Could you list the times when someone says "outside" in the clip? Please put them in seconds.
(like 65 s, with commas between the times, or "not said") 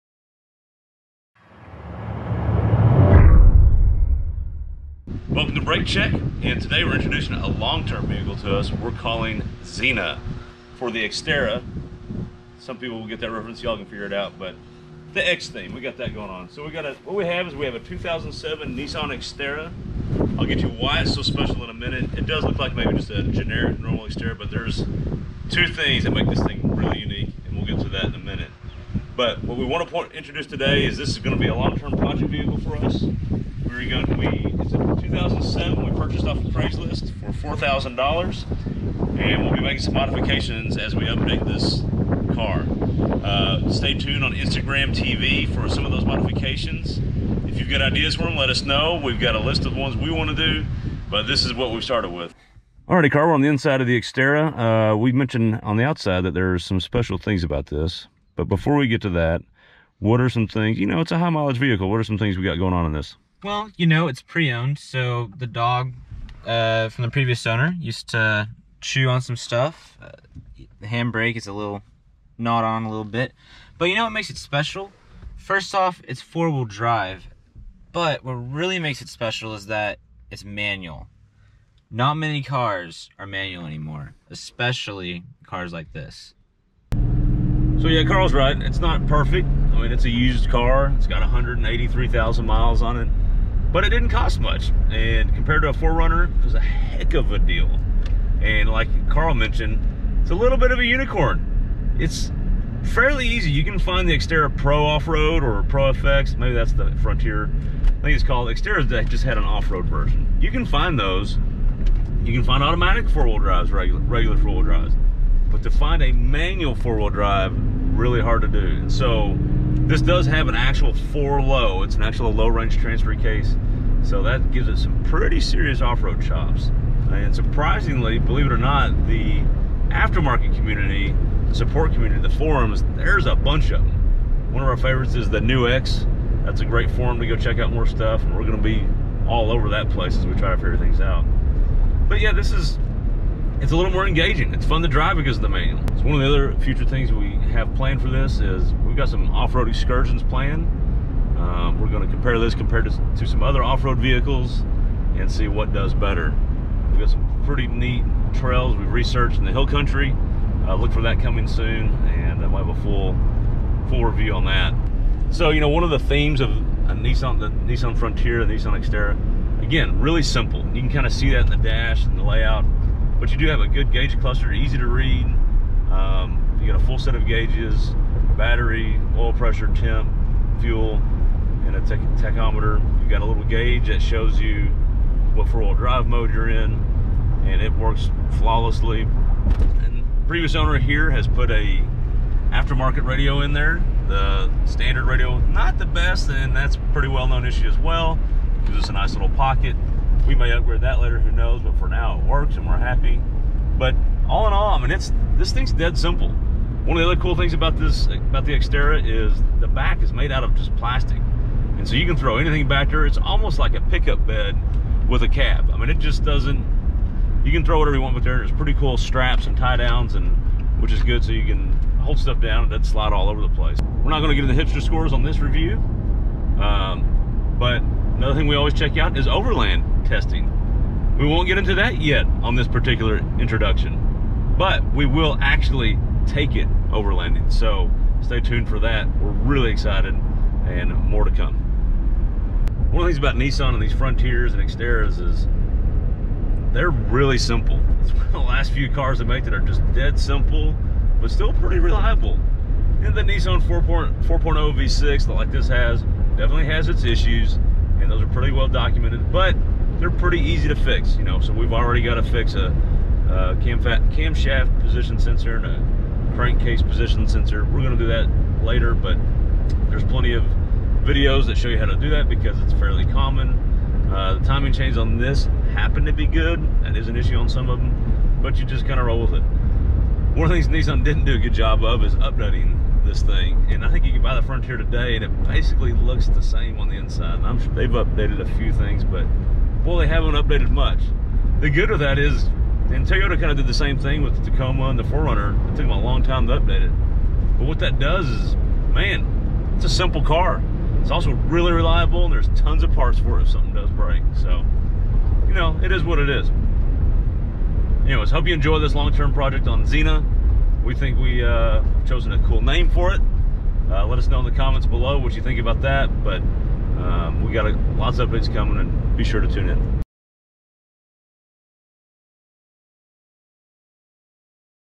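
55 s.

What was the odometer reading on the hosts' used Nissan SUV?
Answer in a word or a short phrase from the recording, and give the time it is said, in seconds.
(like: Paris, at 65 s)
183,000 miles, at 91 s.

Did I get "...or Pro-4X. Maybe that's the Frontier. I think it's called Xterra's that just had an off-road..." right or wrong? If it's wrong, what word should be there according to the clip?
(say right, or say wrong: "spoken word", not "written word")
right.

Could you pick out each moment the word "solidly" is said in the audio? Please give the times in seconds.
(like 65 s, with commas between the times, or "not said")
not said.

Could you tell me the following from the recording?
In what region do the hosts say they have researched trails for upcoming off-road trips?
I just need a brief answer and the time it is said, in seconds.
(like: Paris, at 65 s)
the hill country, at 159 s.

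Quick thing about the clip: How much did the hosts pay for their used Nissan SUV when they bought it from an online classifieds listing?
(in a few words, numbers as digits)
$4,000.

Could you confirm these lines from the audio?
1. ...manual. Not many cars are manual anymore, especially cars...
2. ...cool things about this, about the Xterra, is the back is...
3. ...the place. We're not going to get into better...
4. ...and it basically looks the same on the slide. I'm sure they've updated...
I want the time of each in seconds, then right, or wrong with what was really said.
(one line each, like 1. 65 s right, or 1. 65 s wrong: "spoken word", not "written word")
1. 80 s right
2. 207 s right
3. 223 s wrong: "hipster", not "better"
4. 285 s wrong: "inside", not "slide".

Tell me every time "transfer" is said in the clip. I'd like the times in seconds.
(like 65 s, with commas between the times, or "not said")
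122 s.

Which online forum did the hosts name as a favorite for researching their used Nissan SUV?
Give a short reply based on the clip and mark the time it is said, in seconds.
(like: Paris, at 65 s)
The New X, at 135 s.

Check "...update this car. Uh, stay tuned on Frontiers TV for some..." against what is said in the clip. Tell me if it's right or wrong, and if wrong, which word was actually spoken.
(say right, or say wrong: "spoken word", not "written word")
wrong: "Instagram", not "Frontiers".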